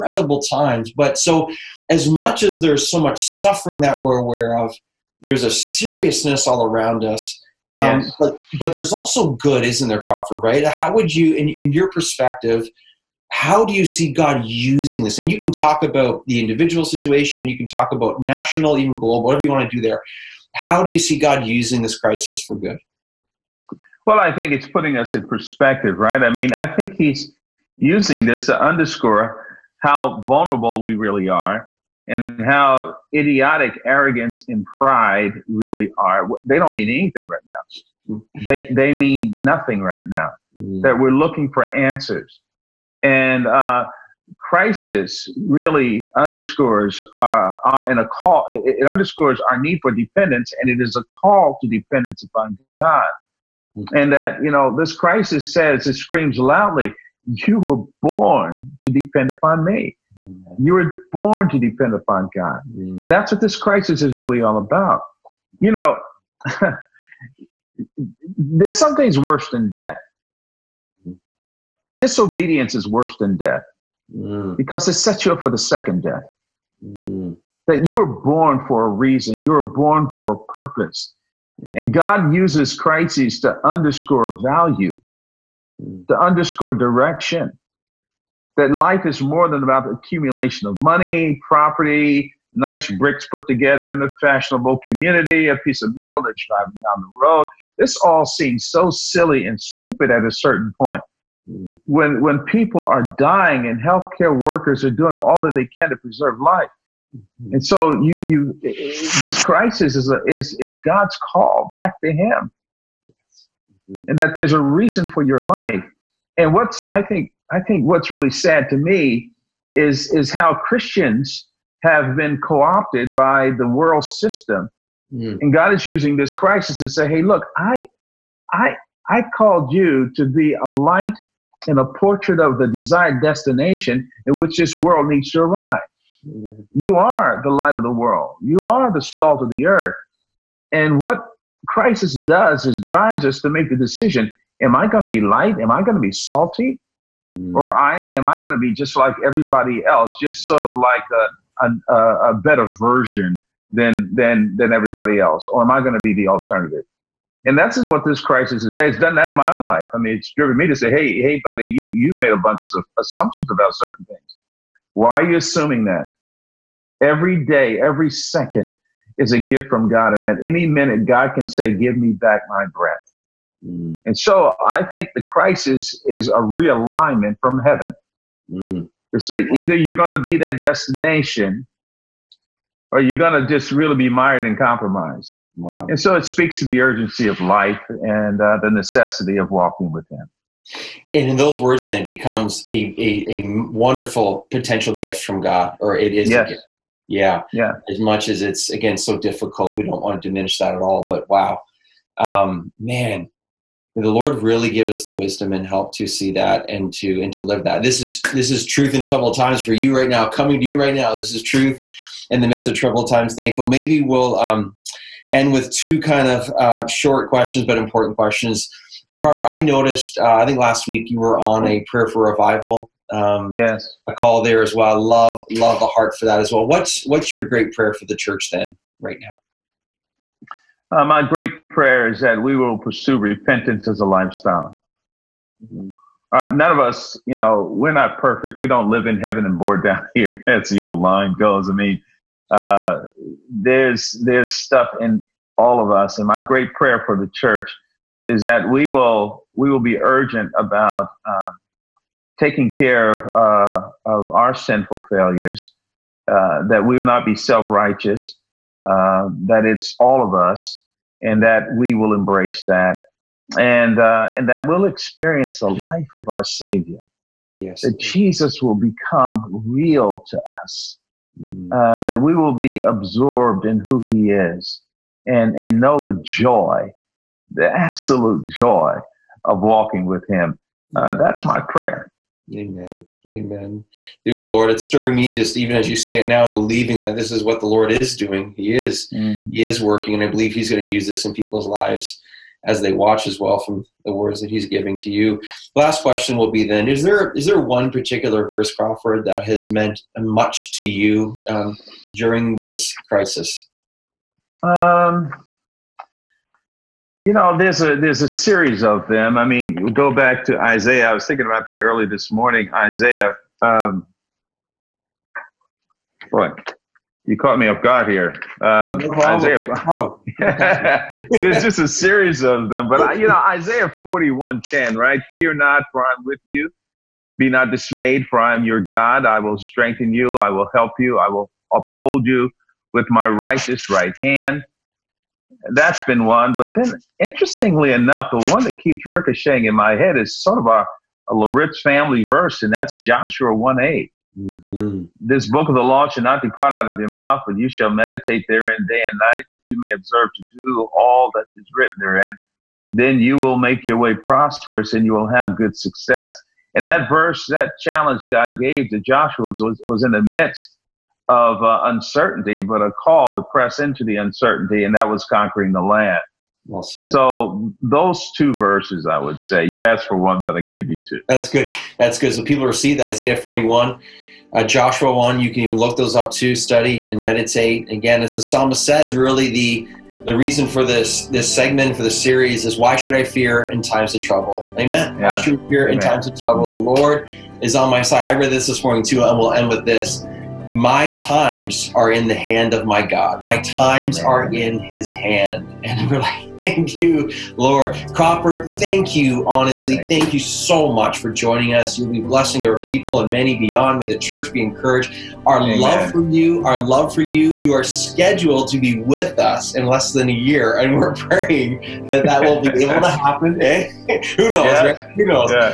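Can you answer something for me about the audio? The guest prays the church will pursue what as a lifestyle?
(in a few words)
Repentance.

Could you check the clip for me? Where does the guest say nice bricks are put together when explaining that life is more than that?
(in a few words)
In a fashionable community.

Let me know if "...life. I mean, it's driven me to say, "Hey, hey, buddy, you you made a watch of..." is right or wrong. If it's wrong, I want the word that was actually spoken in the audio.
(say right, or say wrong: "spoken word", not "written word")
wrong: "bunch", not "watch".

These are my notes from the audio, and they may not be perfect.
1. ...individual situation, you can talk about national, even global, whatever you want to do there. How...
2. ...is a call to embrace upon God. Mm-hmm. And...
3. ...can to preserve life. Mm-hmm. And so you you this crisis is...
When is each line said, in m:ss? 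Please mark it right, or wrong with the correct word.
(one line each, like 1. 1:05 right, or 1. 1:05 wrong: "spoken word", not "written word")
1. 0:16 right
2. 0:50 wrong: "dependence", not "embrace"
3. 1:45 right.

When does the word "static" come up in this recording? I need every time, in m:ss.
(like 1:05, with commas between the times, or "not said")
not said.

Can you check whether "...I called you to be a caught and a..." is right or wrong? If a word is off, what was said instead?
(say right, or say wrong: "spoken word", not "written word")
wrong: "light", not "caught".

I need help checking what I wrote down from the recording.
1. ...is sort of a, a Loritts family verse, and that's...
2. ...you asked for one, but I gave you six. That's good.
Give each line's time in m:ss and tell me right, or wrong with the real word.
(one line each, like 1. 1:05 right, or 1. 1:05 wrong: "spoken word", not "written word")
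1. 5:40 right
2. 6:09 wrong: "two", not "six".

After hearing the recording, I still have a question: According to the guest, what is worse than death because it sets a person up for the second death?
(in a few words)
Disobedience.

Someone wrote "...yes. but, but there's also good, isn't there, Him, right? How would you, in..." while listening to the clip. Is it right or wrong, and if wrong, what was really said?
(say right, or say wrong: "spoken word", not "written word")
wrong: "Crawford", not "Him".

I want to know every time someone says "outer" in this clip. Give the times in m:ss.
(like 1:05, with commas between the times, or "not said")
not said.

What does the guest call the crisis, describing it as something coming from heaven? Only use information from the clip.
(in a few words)
A realignment.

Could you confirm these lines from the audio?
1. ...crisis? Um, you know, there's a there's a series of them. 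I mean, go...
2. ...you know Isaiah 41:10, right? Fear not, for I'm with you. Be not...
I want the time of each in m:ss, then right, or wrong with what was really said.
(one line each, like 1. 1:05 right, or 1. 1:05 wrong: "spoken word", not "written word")
1. 5:03 right
2. 5:23 right.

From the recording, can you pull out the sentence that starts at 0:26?
I mean, I think he's using this to underscore how vulnerable we really are and how idiotic arrogance and pride really are.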